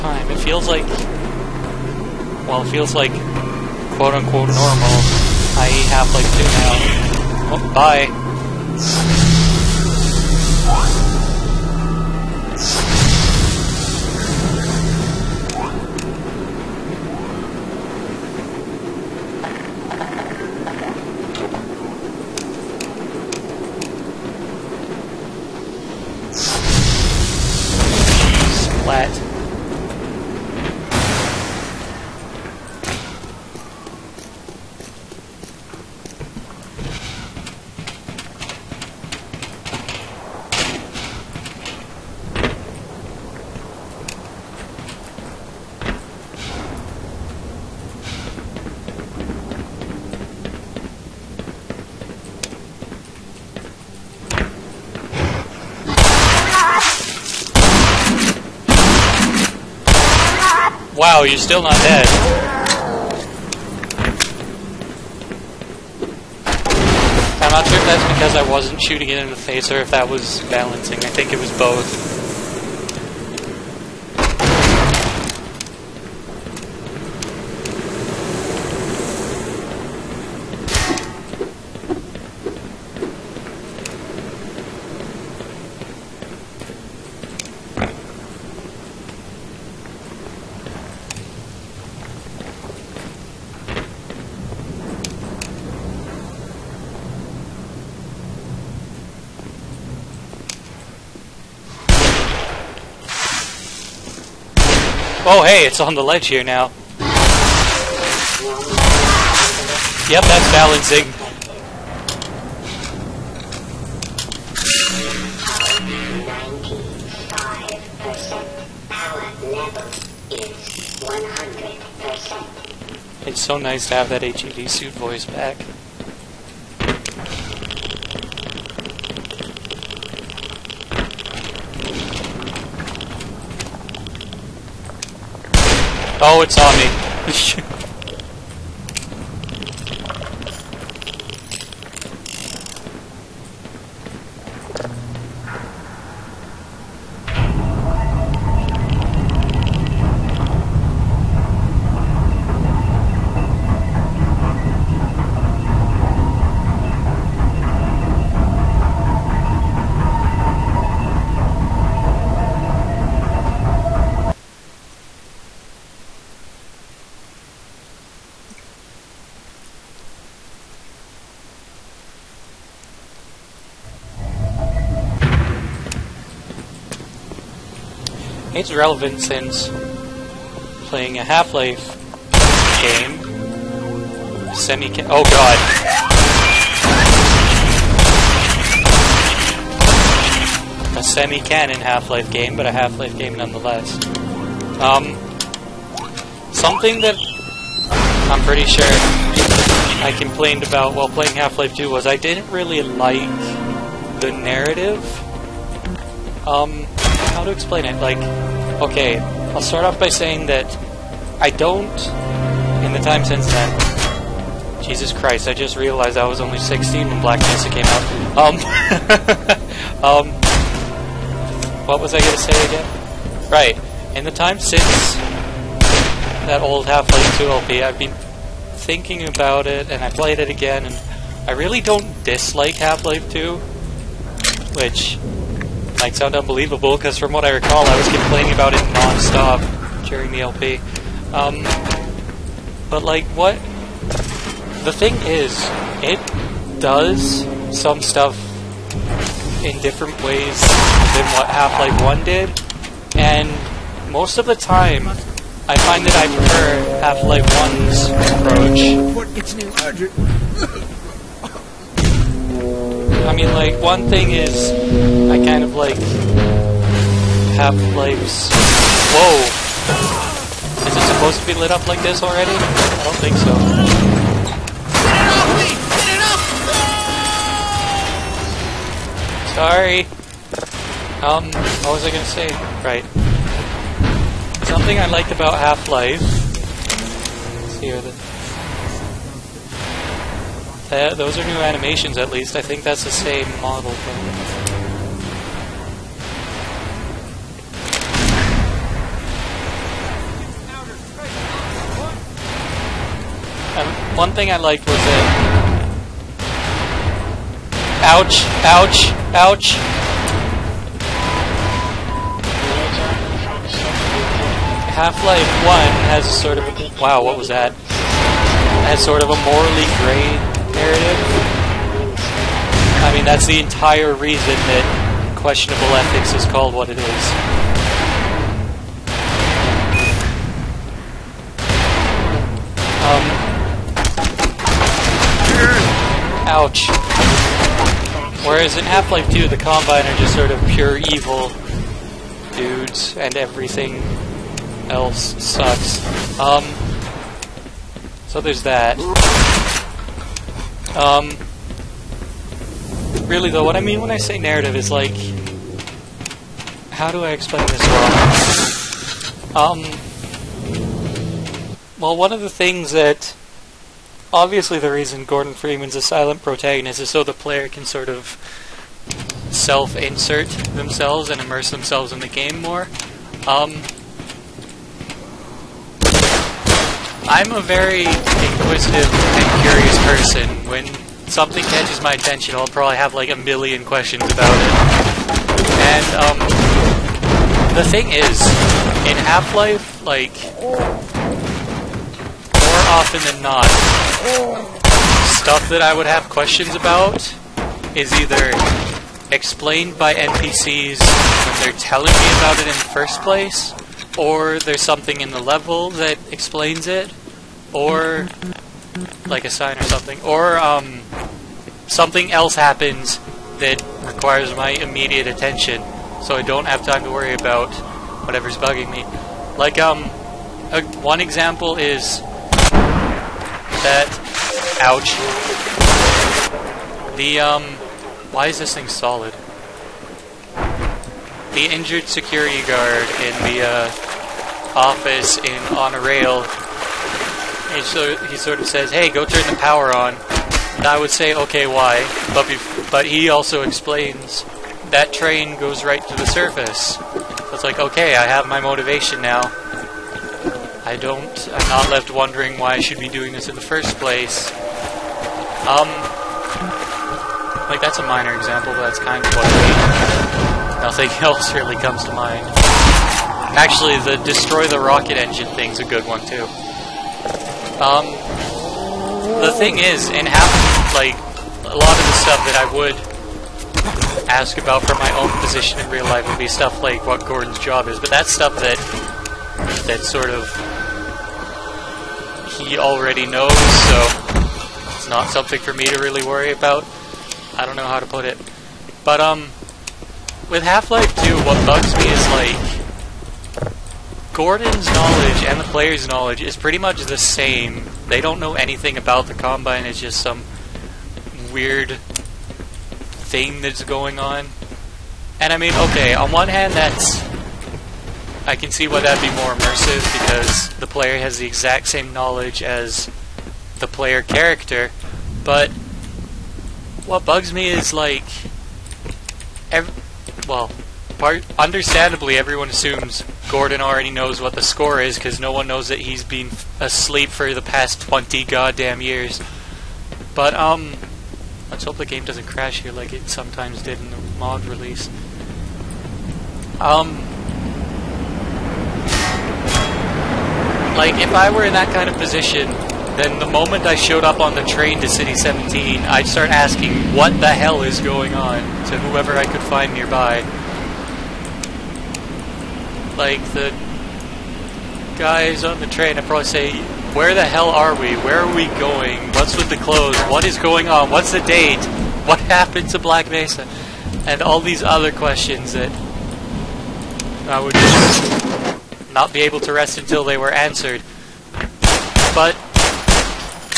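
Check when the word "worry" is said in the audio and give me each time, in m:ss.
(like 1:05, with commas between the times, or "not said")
6:57, 8:06.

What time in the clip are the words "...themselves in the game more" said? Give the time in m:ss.
6:11.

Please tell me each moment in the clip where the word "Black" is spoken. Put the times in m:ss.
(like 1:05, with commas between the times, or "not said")
3:37, 9:22.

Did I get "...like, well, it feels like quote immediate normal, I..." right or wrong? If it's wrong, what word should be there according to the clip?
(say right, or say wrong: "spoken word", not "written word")
wrong: "unquote", not "immediate".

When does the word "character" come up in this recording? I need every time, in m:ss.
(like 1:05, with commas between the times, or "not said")
8:34.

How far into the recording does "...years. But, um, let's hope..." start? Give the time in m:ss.
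8:49.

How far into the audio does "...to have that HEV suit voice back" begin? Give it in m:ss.
2:03.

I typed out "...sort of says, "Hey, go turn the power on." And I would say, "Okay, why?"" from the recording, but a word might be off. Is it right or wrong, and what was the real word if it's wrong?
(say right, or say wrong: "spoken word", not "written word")
right.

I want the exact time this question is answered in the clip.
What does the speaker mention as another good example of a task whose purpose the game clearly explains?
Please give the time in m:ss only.
7:44.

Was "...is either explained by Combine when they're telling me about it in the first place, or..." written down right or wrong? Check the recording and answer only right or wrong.
wrong.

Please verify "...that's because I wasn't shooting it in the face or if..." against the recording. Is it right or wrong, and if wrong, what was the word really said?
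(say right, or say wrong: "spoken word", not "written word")
right.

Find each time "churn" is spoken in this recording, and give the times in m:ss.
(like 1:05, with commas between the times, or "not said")
not said.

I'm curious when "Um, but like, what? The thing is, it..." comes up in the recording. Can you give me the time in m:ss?
4:01.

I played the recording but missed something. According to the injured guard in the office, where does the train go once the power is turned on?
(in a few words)
the surface.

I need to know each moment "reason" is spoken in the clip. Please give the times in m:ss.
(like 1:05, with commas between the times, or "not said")
5:24, 6:04.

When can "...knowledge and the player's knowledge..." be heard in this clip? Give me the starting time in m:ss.
8:14.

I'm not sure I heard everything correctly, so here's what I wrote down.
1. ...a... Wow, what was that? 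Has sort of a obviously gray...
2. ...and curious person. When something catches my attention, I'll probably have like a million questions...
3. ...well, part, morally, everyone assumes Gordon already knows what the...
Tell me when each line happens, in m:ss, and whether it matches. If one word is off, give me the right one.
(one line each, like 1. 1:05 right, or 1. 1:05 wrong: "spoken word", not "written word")
1. 5:16 wrong: "morally", not "obviously"
2. 6:19 right
3. 8:40 wrong: "understandably", not "morally".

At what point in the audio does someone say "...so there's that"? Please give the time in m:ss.
5:48.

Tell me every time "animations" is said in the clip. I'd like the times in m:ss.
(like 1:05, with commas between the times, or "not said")
4:51.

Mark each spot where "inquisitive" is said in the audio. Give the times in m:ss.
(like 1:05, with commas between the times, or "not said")
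6:18.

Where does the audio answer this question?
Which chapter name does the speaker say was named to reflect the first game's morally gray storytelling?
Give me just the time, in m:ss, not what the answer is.
5:25.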